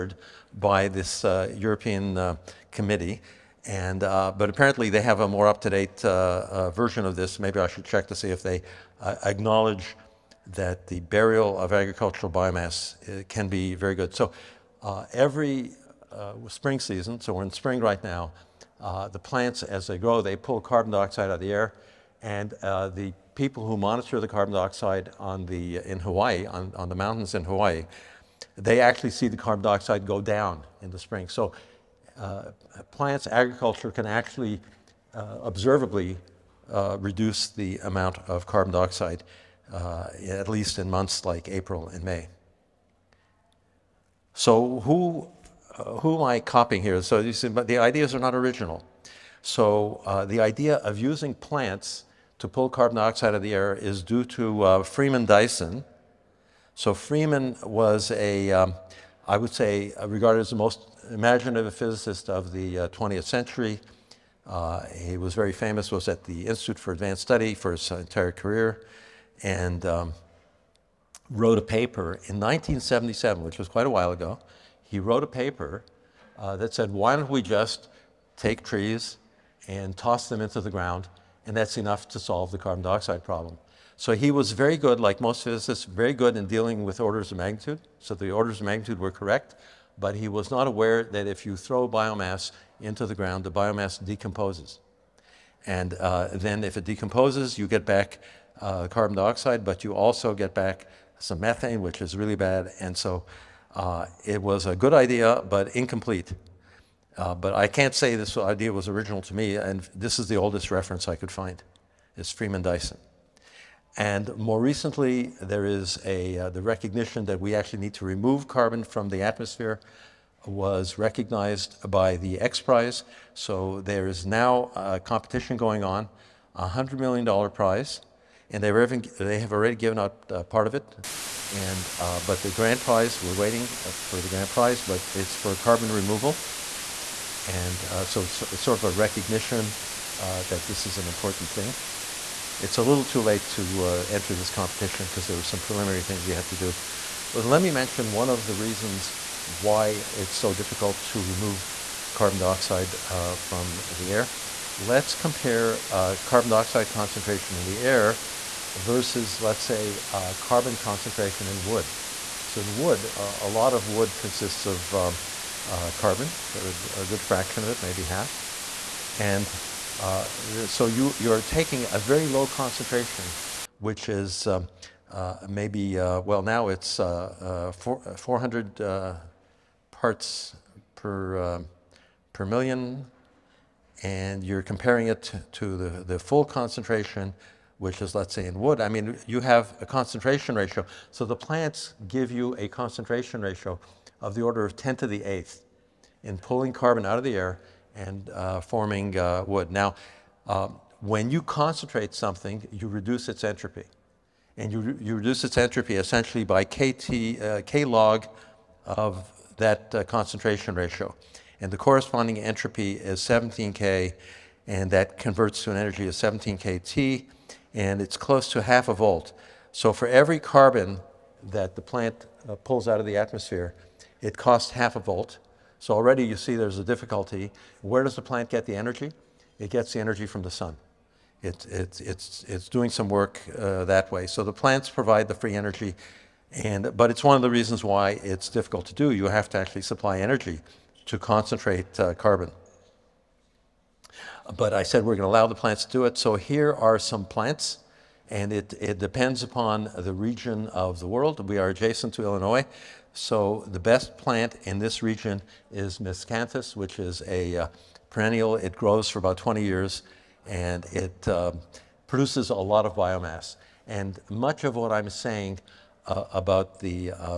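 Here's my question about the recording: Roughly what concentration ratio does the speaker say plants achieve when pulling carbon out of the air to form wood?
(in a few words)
10^8.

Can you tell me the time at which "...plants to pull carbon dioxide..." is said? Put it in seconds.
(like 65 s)
51 s.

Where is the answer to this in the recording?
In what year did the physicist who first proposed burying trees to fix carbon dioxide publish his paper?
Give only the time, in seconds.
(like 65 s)
72 s.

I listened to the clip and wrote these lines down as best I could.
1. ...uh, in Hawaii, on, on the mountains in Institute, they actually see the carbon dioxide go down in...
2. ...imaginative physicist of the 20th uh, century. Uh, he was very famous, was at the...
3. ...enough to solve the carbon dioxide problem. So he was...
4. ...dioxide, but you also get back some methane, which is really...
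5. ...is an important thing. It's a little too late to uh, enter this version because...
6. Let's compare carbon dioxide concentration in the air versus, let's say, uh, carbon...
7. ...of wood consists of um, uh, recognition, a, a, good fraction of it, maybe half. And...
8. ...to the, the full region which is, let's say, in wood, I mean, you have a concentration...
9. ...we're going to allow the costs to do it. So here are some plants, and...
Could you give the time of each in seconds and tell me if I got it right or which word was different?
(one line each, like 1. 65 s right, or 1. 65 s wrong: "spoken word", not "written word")
1. 25 s wrong: "Hawaii", not "Institute"
2. 61 s right
3. 81 s right
4. 99 s right
5. 140 s wrong: "competition", not "version"
6. 154 s right
7. 163 s wrong: "carbon", not "recognition"
8. 185 s wrong: "concentration", not "region"
9. 245 s wrong: "plants", not "costs".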